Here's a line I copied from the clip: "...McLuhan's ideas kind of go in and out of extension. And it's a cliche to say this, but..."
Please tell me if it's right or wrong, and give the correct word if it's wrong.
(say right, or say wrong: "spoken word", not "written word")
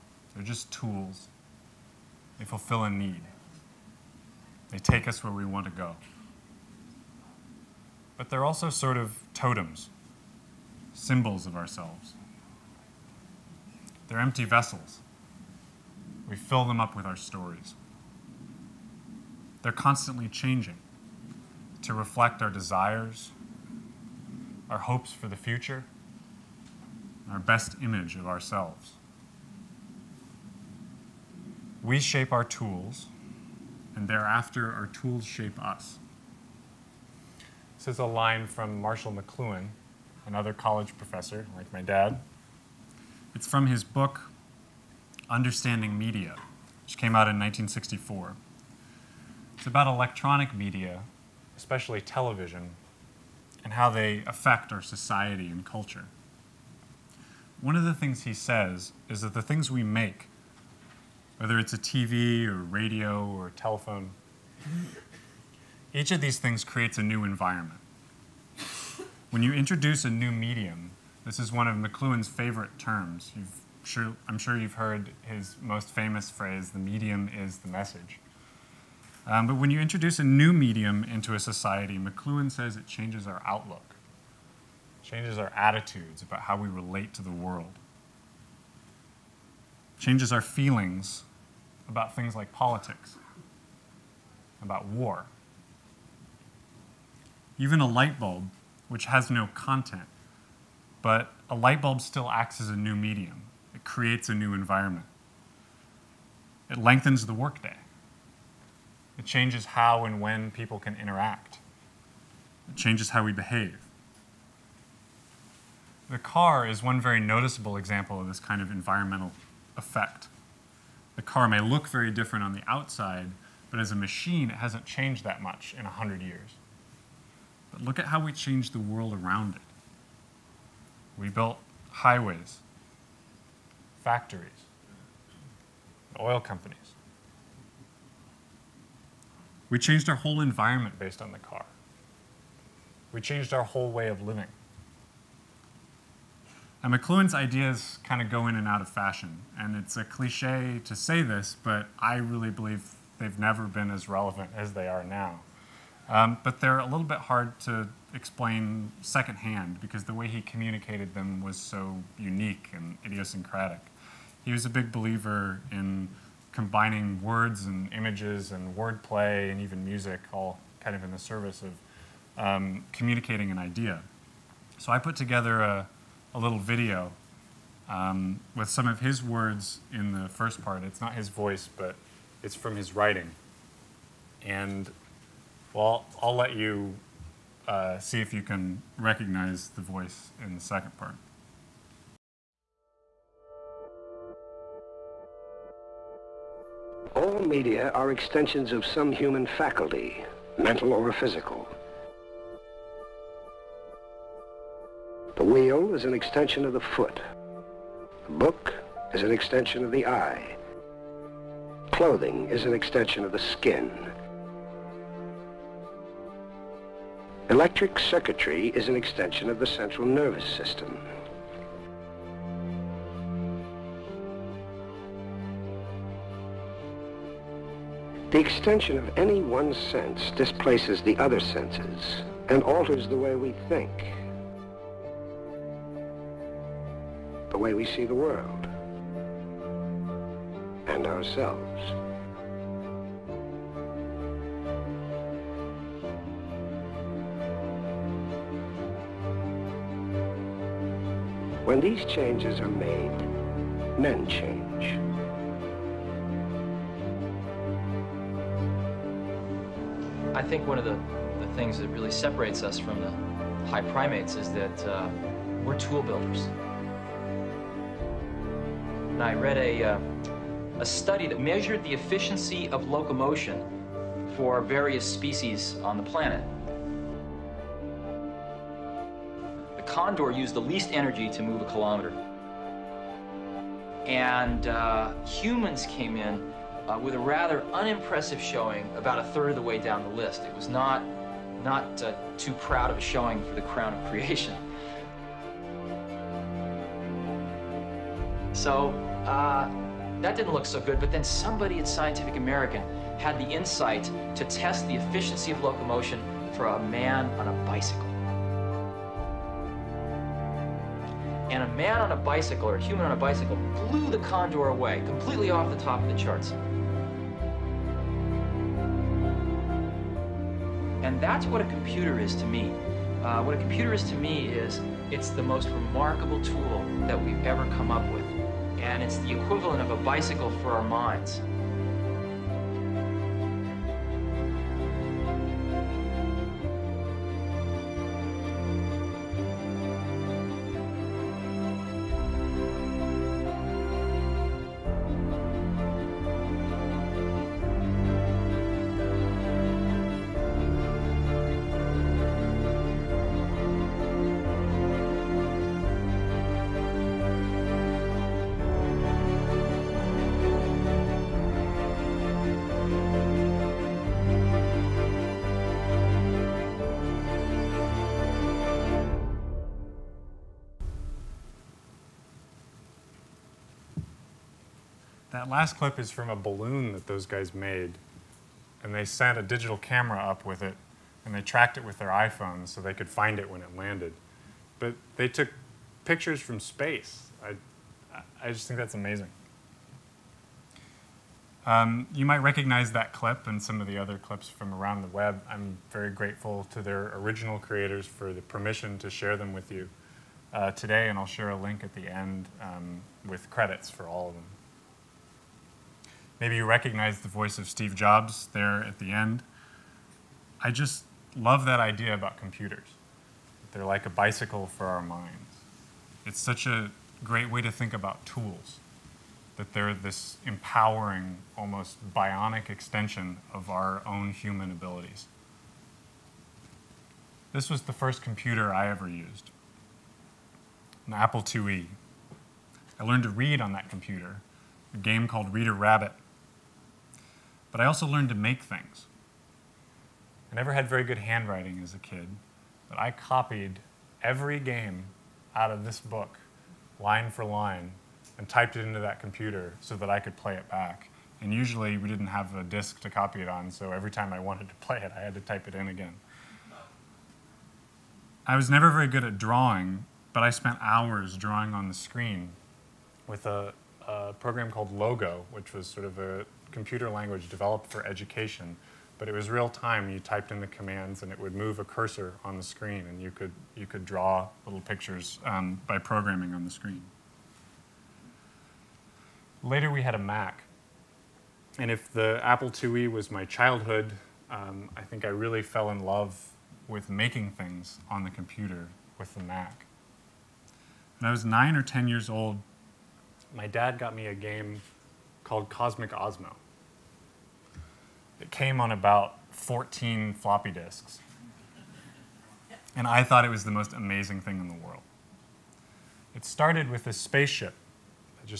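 wrong: "fashion", not "extension".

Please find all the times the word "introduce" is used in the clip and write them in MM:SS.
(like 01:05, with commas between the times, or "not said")
01:09, 01:19.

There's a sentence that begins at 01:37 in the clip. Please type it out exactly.
Even a light bulb, which has no content, but a light bulb still acts as a new medium.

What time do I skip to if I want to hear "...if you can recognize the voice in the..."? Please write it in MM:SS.
03:08.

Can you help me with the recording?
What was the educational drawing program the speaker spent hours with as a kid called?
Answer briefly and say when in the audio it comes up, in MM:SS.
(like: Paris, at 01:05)
Logo, at 07:44.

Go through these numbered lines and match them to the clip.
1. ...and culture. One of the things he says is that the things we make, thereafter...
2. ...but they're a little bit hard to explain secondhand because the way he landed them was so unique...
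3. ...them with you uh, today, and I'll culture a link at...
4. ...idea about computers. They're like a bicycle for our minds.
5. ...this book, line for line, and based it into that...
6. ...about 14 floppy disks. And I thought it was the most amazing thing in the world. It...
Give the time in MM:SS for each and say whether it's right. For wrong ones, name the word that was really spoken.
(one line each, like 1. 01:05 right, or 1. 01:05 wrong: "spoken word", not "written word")
1. 00:55 wrong: "whether", not "thereafter"
2. 02:36 wrong: "communicated", not "landed"
3. 06:39 wrong: "share", not "culture"
4. 06:51 right
5. 07:25 wrong: "typed", not "based"
6. 08:18 right.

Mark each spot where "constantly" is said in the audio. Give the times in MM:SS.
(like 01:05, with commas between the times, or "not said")
00:19.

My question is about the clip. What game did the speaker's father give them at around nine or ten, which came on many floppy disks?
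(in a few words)
Cosmic Osmo.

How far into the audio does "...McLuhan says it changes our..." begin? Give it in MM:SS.
01:21.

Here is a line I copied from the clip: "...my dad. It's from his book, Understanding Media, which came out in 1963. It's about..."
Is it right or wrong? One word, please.
wrong.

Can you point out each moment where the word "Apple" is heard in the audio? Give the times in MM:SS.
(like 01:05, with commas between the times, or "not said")
07:11, 08:02.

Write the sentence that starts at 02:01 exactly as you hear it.
The car may look very different on the outside, but as a machine, it hasn't changed that much in 100 years.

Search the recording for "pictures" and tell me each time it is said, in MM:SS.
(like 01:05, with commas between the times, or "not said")
06:26, 07:54.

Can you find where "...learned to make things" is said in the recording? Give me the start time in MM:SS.
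07:18.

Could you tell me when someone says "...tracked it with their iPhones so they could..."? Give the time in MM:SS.
06:21.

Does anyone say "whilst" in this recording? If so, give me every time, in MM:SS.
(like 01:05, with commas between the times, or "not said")
not said.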